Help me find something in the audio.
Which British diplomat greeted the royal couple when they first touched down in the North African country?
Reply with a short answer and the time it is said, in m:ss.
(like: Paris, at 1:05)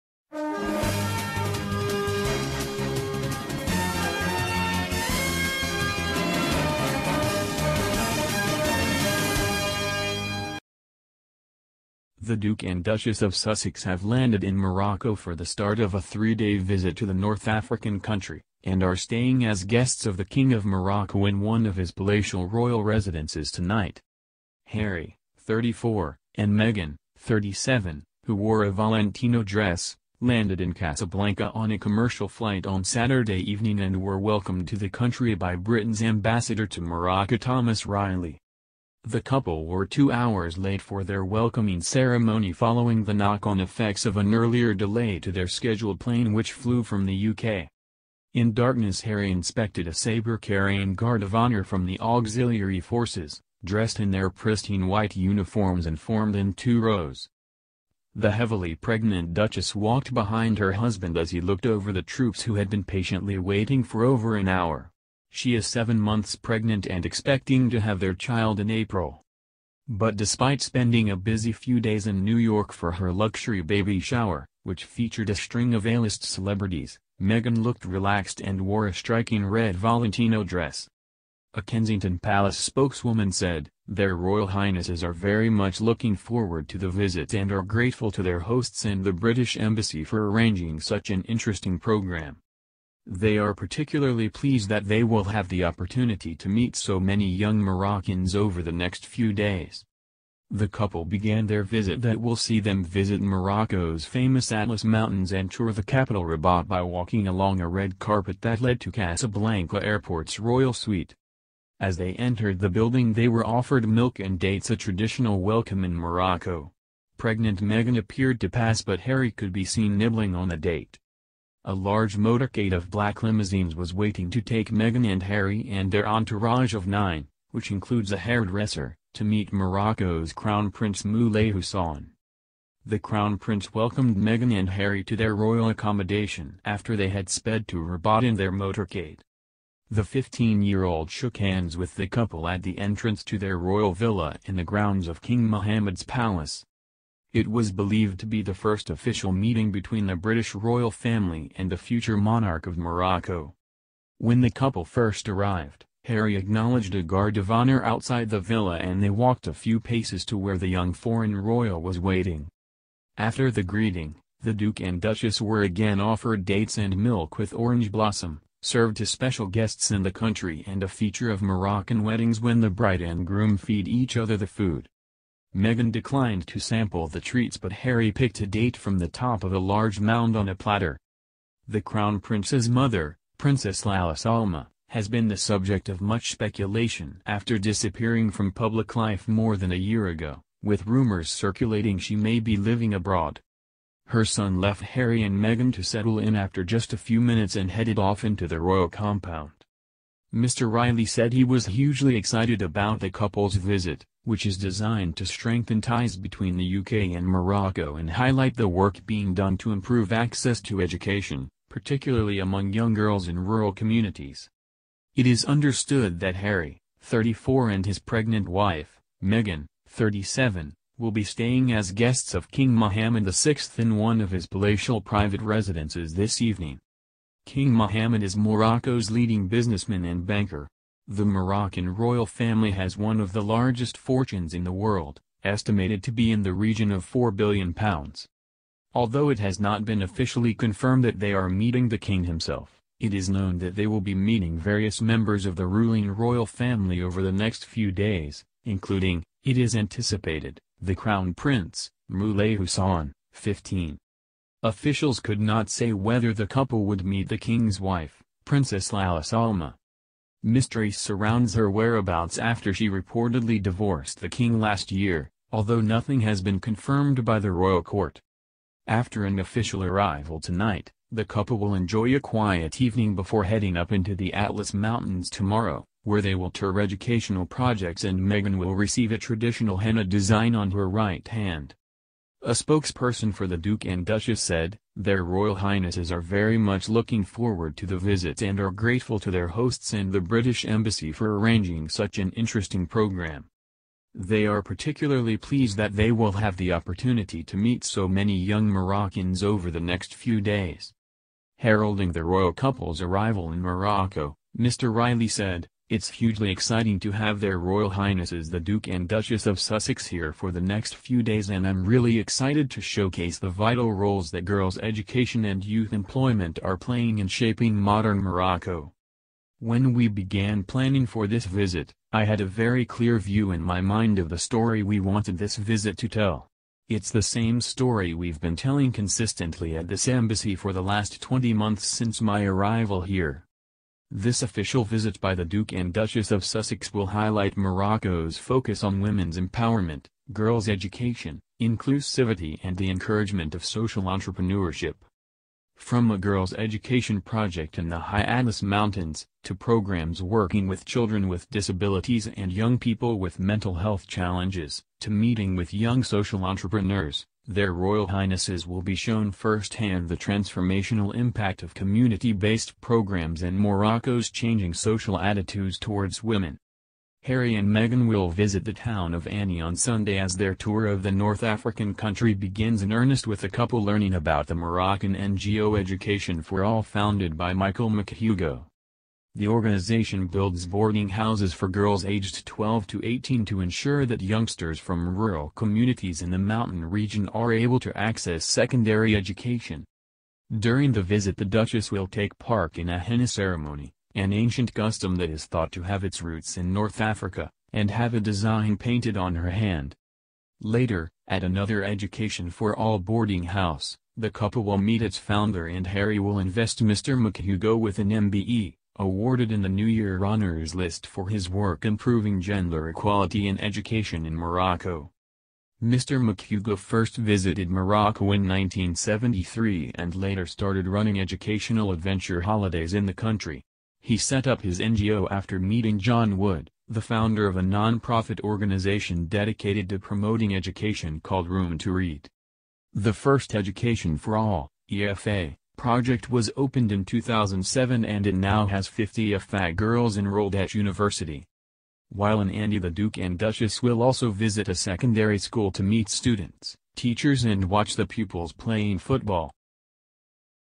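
Thomas Reilly, at 0:37.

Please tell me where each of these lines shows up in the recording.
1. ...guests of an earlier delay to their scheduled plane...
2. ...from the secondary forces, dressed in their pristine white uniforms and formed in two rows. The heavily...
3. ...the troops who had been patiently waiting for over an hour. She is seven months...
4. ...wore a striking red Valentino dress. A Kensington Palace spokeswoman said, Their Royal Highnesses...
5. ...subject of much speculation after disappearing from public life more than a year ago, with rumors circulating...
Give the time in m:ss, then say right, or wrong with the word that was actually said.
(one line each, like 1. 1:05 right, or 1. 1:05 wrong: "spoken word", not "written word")
1. 0:43 wrong: "effects", not "guests"
2. 0:51 wrong: "auxiliary", not "secondary"
3. 1:01 right
4. 1:18 right
5. 3:05 right.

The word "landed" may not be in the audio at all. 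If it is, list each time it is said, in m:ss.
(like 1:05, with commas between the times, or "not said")
0:14, 0:30.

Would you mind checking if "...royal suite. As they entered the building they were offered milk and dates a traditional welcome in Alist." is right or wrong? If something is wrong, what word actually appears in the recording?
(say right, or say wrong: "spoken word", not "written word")
wrong: "Morocco", not "Alist".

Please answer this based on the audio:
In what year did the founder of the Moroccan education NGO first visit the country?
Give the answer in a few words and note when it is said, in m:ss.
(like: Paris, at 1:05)
1973, at 6:58.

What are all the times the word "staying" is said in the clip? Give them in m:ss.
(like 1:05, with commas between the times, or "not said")
0:18, 3:41.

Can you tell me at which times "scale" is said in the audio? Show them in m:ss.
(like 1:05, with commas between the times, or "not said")
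not said.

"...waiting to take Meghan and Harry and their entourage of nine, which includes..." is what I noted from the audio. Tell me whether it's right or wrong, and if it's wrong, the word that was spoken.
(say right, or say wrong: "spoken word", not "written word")
right.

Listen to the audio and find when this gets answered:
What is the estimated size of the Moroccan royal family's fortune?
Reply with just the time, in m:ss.
3:57.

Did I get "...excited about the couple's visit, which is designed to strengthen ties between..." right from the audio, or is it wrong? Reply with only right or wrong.
right.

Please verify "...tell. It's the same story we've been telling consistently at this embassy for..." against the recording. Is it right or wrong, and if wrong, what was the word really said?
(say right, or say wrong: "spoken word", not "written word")
right.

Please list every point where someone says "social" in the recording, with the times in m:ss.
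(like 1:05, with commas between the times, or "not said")
5:43, 5:56, 6:04.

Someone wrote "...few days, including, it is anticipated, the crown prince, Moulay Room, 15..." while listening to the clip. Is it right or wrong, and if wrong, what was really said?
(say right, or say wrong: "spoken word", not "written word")
wrong: "Hassan", not "Room".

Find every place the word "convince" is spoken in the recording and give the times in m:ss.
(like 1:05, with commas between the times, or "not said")
not said.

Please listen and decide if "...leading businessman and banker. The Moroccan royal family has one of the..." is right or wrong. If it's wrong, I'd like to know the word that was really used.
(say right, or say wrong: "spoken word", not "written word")
right.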